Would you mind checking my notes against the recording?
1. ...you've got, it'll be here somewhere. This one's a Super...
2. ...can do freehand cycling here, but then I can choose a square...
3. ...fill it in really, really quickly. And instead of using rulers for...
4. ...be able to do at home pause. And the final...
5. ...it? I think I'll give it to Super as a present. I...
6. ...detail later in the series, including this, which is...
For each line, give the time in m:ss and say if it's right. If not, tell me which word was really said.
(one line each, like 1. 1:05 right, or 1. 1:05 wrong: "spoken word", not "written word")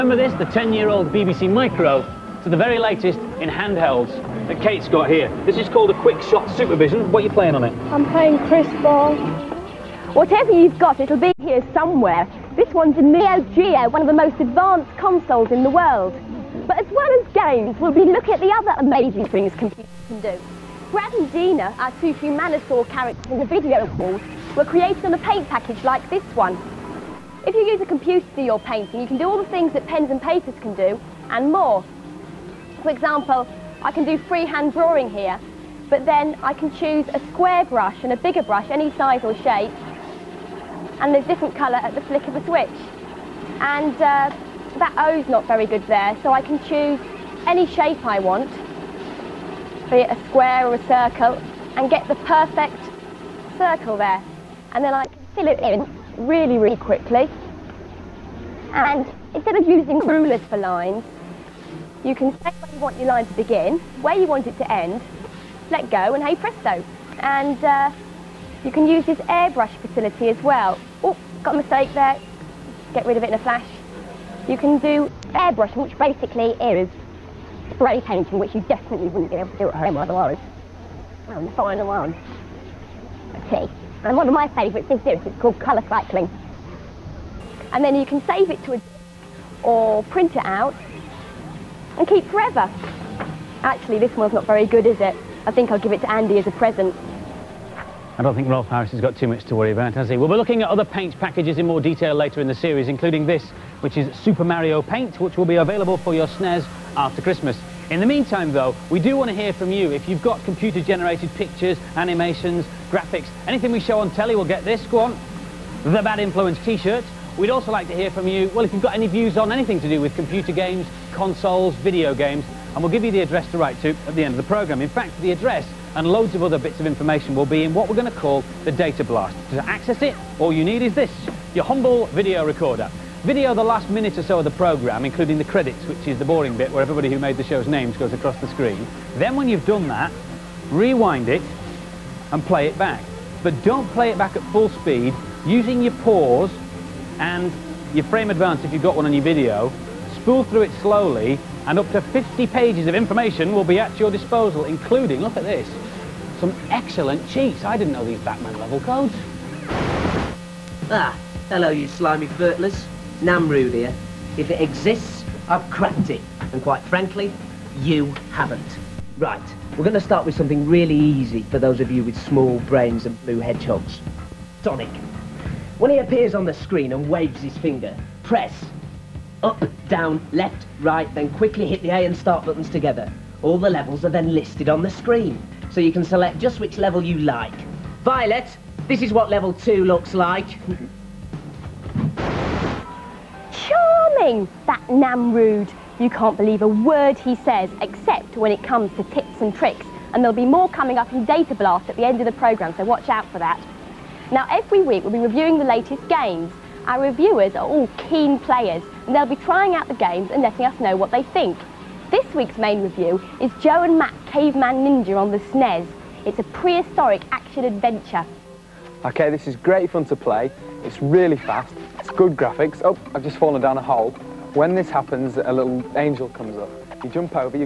1. 0:10 wrong: "Neo", not "Super"
2. 0:33 wrong: "drawing", not "cycling"
3. 0:55 right
4. 1:19 wrong: "otherwise", not "pause"
5. 1:35 wrong: "Andy", not "Super"
6. 1:41 right.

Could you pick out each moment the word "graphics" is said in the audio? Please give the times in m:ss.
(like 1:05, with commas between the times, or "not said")
1:52, 3:42.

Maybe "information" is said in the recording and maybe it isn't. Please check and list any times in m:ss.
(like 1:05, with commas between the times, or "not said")
2:06, 2:32.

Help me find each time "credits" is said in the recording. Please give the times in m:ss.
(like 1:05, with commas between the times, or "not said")
2:15.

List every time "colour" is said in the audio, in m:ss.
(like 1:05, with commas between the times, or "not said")
0:41, 1:25.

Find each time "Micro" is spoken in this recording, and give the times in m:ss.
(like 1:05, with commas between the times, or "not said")
0:01.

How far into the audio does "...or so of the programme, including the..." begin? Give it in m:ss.
2:14.